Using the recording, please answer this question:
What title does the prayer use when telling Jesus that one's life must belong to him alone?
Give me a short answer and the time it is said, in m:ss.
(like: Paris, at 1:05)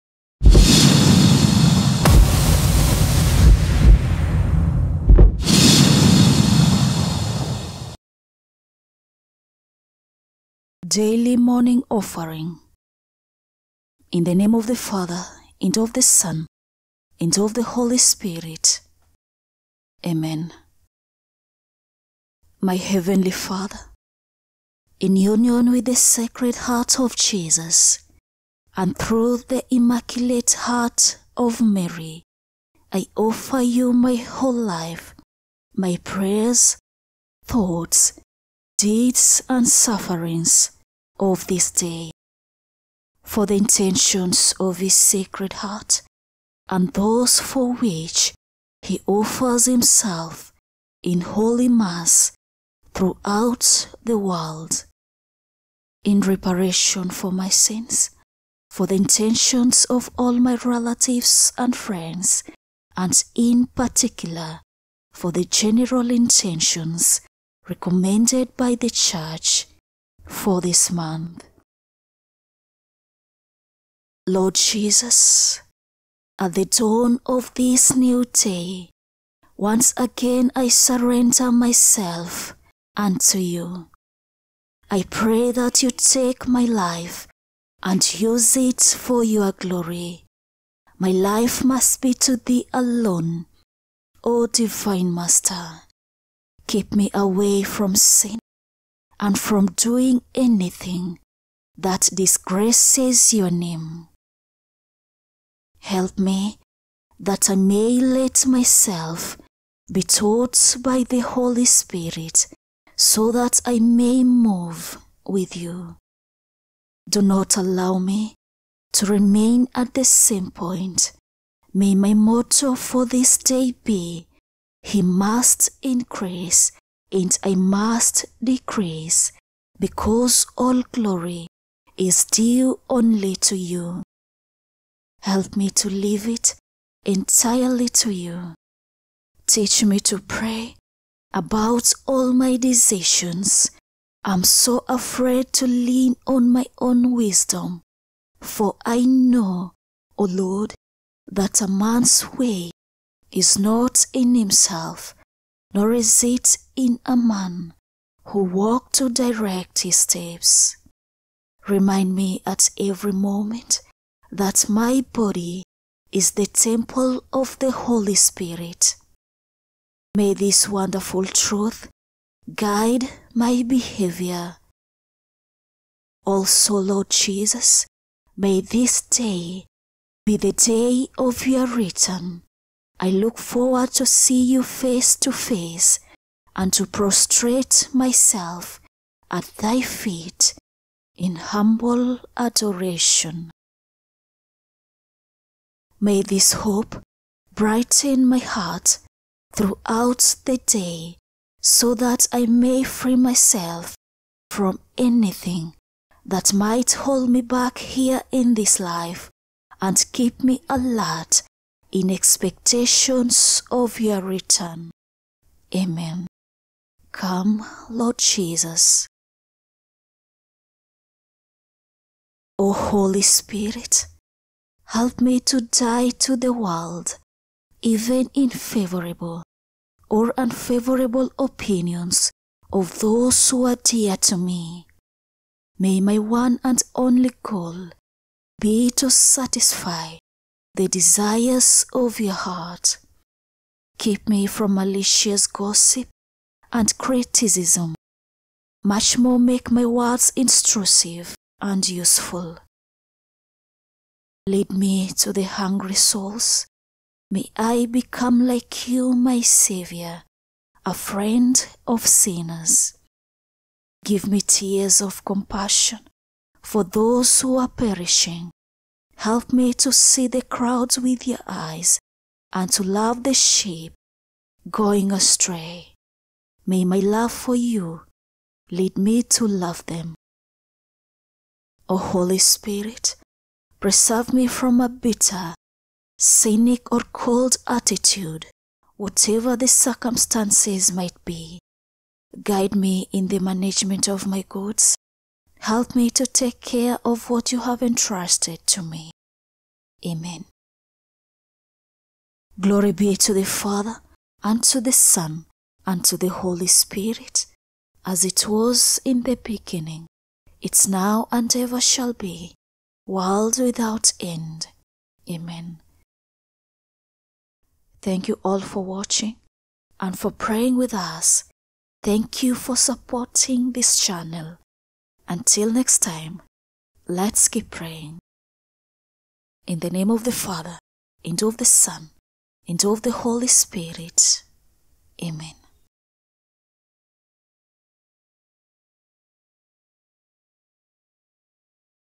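Divine Master, at 1:34.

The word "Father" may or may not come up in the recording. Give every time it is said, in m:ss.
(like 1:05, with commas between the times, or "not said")
0:14, 0:23, 5:03, 5:30.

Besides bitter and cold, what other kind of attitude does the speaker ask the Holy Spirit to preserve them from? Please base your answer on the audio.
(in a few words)
cynic.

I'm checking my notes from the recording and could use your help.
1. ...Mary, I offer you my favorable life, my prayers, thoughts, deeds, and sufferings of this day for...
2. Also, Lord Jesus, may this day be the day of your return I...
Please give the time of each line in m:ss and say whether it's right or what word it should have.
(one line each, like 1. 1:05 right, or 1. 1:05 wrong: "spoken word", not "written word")
1. 0:31 wrong: "whole", not "favorable"
2. 2:56 right.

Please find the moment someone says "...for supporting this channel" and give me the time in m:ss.
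5:22.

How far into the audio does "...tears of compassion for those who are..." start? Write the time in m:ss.
4:24.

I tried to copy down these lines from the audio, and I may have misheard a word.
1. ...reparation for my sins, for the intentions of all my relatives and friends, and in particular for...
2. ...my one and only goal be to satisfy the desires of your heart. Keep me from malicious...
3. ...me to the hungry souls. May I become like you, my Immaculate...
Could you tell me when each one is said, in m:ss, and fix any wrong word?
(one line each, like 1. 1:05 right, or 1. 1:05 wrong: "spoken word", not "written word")
1. 0:56 right
2. 3:55 right
3. 4:14 wrong: "Saviour", not "Immaculate".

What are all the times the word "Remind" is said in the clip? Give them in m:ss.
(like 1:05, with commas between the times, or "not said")
2:41.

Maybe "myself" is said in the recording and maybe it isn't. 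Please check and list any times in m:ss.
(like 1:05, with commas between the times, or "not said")
1:21, 1:48, 3:07, 3:23.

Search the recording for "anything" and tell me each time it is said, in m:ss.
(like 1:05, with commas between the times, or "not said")
1:40, 3:24.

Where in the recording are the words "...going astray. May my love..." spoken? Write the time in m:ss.
4:34.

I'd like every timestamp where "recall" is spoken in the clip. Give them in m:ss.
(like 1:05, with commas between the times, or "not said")
not said.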